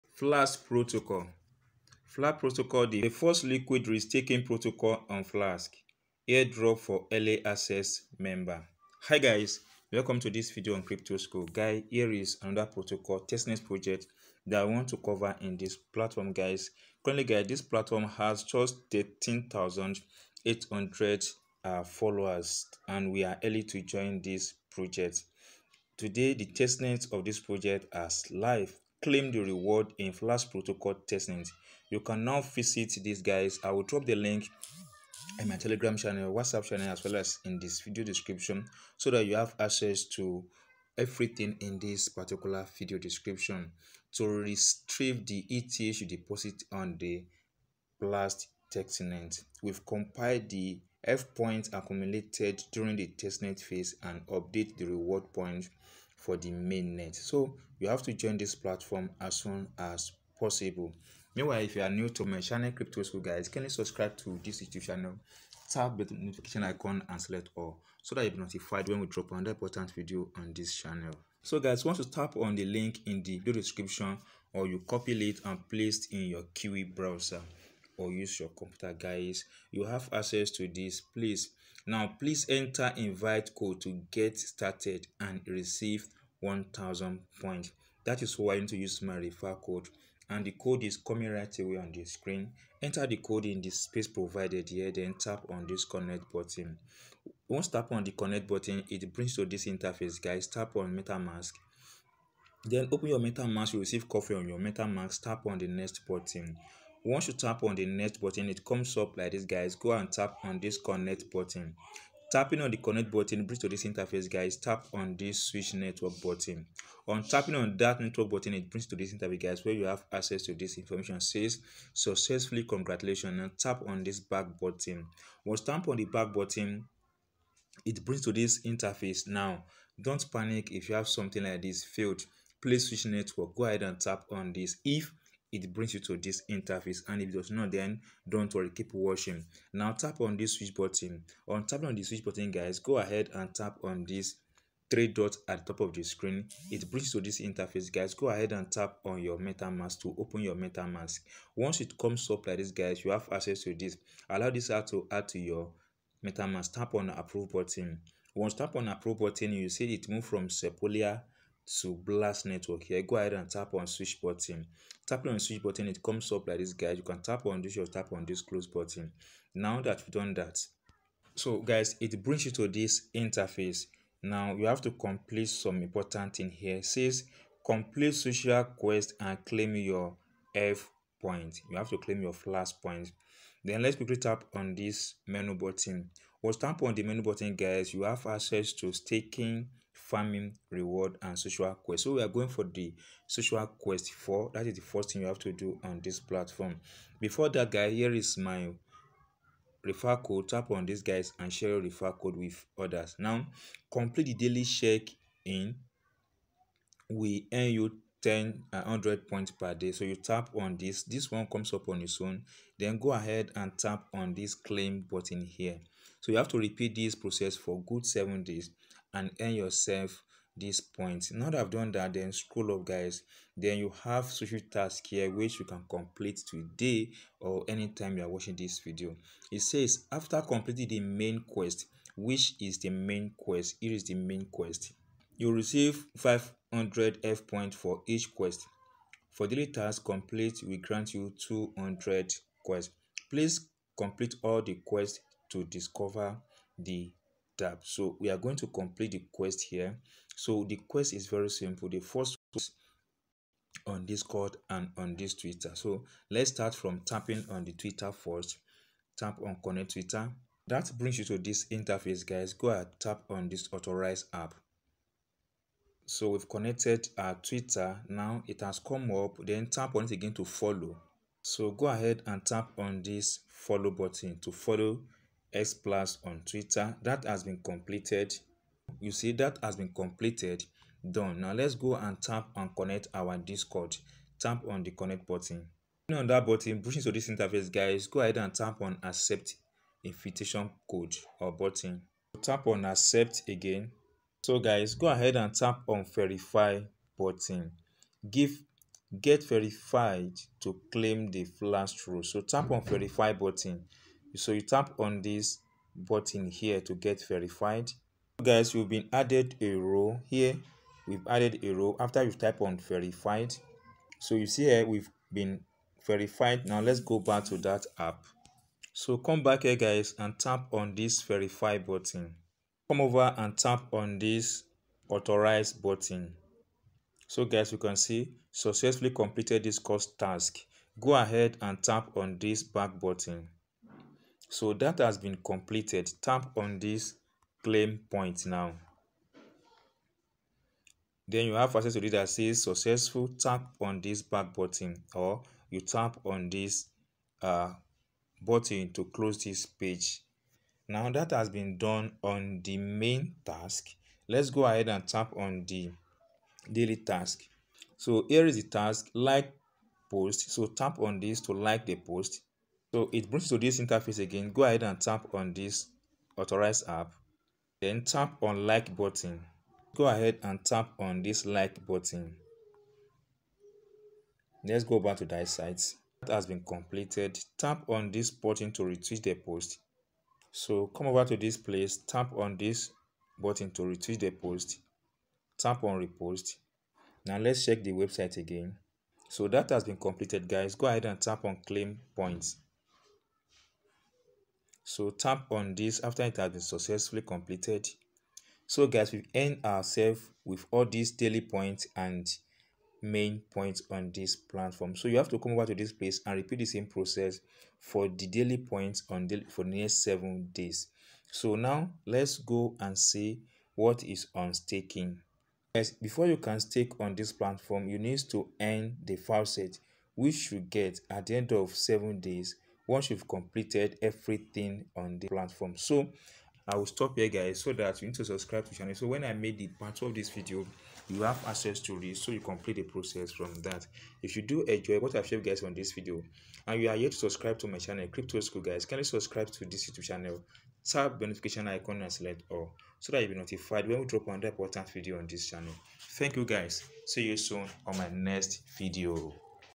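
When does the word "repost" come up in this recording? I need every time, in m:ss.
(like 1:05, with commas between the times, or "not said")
6:26.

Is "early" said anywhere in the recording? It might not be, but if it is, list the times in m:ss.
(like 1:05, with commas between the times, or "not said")
0:07, 0:23.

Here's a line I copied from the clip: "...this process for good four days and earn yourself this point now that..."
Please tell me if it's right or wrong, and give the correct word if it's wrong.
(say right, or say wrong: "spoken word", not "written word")
wrong: "seven", not "four".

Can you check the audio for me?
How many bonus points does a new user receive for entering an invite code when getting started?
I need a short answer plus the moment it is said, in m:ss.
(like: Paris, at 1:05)
1000, at 1:26.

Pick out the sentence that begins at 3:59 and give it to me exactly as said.
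For daily task complete, we grant you 200 quests.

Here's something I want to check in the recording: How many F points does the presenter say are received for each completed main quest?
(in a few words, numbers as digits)
500.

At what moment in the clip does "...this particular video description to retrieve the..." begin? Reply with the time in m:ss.
0:41.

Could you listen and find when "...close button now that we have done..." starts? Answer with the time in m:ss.
2:48.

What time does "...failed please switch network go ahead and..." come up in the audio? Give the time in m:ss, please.
2:11.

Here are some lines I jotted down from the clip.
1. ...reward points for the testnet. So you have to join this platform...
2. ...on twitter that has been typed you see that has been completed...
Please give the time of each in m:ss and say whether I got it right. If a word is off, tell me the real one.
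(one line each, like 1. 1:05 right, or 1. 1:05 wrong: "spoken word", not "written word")
1. 0:54 wrong: "mainnet", not "testnet"
2. 4:36 wrong: "completed", not "typed".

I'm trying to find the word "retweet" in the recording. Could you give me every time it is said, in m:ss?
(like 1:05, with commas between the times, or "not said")
6:18, 6:23.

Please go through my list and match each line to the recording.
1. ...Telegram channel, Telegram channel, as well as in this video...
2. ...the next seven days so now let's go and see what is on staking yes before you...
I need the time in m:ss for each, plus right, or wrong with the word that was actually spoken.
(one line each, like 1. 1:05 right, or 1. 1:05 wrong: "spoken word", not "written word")
1. 0:35 wrong: "WhatsApp", not "Telegram"
2. 6:49 right.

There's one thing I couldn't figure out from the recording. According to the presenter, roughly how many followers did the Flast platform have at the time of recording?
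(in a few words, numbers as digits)
13,800.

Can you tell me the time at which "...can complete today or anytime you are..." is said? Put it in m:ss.
3:45.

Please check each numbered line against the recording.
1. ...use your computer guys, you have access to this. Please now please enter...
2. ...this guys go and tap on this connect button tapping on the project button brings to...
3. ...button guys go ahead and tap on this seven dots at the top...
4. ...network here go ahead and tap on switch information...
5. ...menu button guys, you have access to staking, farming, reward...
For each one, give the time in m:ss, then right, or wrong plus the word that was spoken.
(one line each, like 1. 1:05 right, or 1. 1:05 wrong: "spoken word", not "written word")
1. 1:18 right
2. 1:49 wrong: "connect", not "project"
3. 2:22 wrong: "three", not "seven"
4. 2:42 wrong: "button", not "information"
5. 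3:07 right.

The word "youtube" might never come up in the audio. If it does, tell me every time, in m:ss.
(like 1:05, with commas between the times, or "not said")
1:04, 7:19.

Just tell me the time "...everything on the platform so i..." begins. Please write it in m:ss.
7:04.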